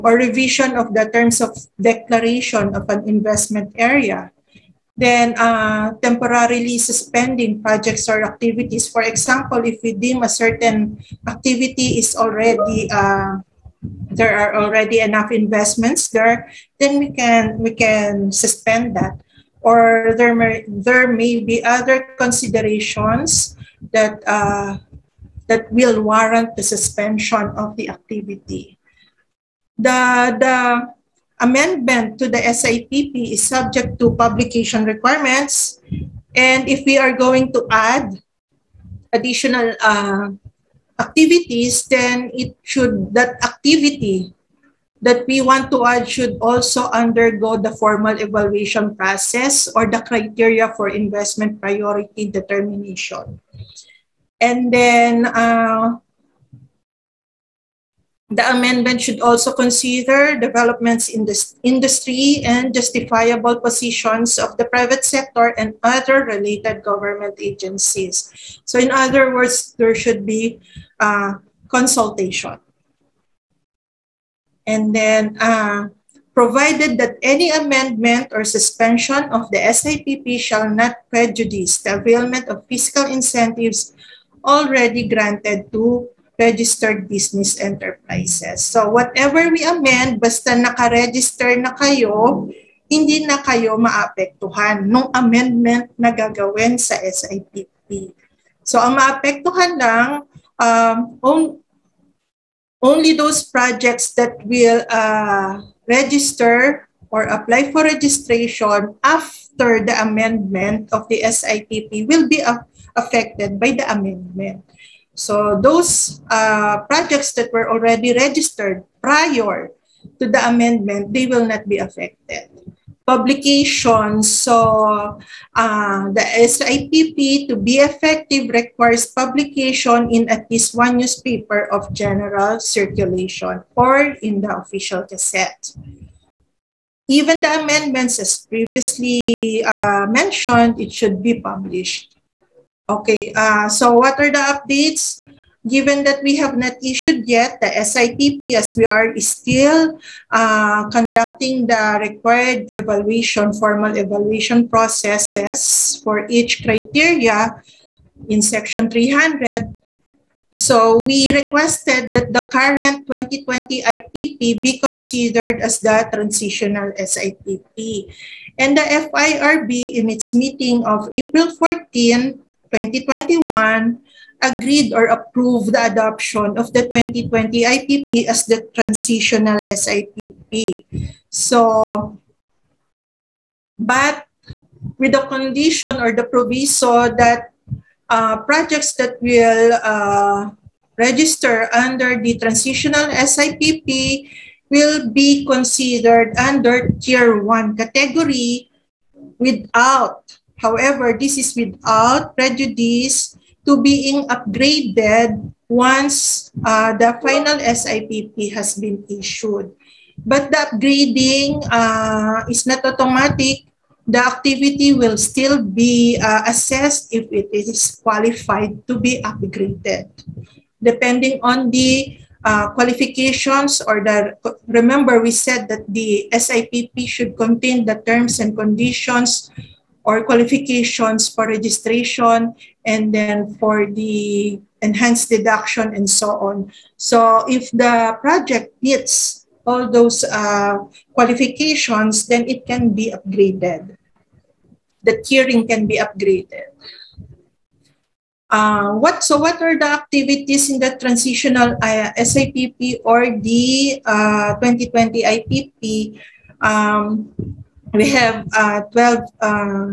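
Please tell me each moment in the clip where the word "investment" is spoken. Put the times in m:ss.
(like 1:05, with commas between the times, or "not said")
0:03, 0:15, 0:50.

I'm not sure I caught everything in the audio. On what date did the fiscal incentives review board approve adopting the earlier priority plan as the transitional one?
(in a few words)
April 14, 2021.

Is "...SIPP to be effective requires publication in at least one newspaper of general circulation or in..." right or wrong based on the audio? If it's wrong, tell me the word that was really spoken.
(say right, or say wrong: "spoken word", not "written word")
right.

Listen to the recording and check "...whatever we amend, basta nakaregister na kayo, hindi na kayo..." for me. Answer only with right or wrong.
right.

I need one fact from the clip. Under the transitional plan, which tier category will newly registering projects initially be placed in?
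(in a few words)
Tier one.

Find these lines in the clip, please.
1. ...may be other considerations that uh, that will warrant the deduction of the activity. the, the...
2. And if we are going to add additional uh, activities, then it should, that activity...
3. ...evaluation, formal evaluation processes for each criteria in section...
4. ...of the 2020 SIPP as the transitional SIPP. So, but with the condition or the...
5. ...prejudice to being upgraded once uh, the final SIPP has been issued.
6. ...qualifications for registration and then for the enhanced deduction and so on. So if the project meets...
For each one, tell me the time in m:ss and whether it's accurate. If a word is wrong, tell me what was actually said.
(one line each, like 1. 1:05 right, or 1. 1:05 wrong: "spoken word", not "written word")
1. 0:21 wrong: "suspension", not "deduction"
2. 0:36 right
3. 2:32 right
4. 2:56 wrong: "IPP", not "SIPP"
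5. 3:22 right
6. 3:50 right.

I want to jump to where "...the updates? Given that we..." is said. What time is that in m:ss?
2:24.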